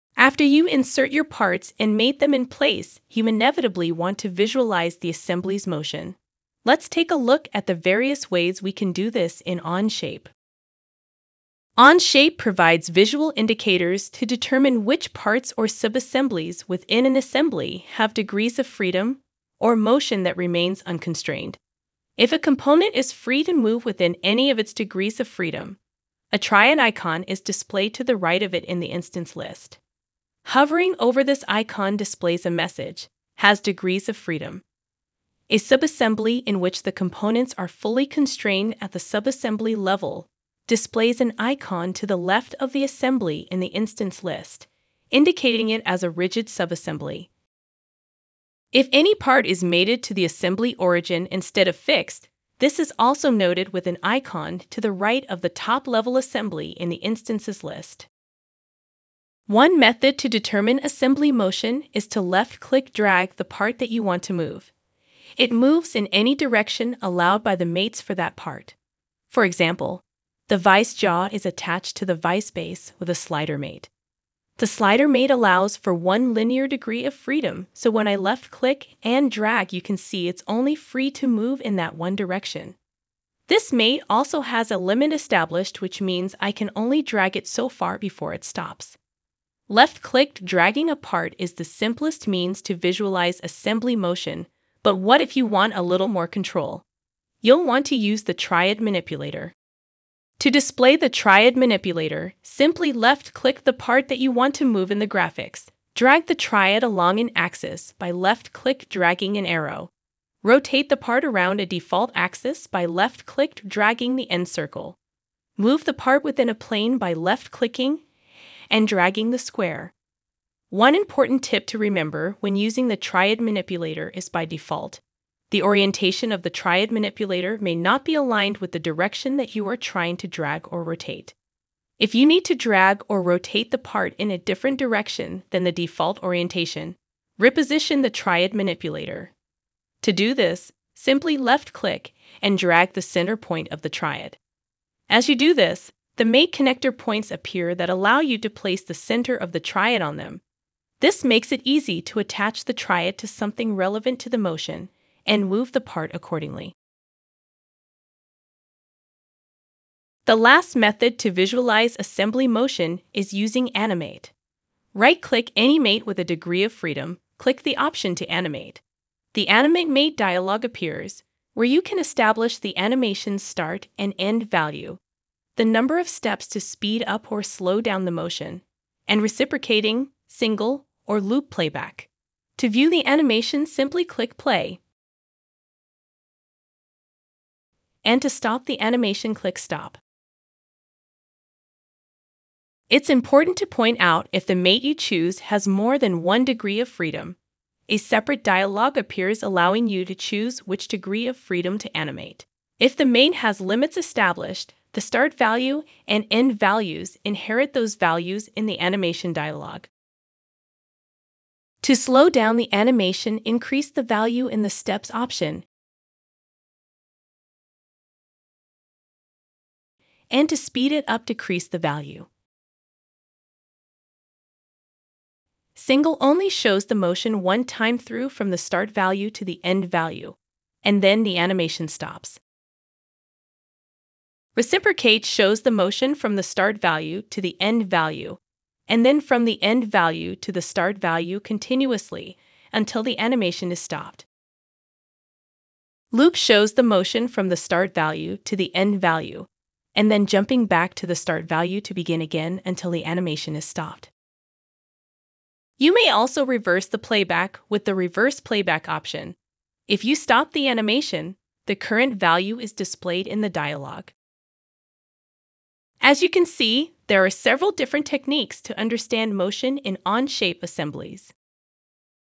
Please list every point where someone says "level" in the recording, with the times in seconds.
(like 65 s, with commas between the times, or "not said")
39 s, 55 s.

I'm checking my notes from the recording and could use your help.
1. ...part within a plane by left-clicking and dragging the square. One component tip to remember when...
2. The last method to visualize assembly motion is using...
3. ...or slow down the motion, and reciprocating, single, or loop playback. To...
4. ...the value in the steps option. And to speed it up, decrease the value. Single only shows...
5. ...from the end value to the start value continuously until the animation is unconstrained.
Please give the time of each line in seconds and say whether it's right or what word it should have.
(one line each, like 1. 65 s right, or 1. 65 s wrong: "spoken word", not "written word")
1. 115 s wrong: "important", not "component"
2. 160 s right
3. 177 s right
4. 213 s right
5. 239 s wrong: "stopped", not "unconstrained".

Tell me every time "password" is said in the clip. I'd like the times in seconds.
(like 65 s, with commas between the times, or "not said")
not said.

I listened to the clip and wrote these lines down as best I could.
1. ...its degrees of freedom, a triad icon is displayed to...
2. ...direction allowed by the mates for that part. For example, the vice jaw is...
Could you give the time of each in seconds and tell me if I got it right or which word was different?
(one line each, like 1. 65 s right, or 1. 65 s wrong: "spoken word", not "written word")
1. 24 s right
2. 66 s right.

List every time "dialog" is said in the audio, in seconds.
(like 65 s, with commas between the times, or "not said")
170 s, 198 s, 209 s, 263 s.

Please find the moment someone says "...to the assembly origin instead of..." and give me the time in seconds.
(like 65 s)
50 s.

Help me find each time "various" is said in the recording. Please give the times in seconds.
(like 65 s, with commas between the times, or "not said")
7 s.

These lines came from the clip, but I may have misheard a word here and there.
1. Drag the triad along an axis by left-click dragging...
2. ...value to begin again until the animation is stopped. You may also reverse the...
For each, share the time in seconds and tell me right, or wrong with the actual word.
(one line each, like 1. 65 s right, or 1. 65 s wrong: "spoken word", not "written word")
1. 105 s right
2. 251 s right.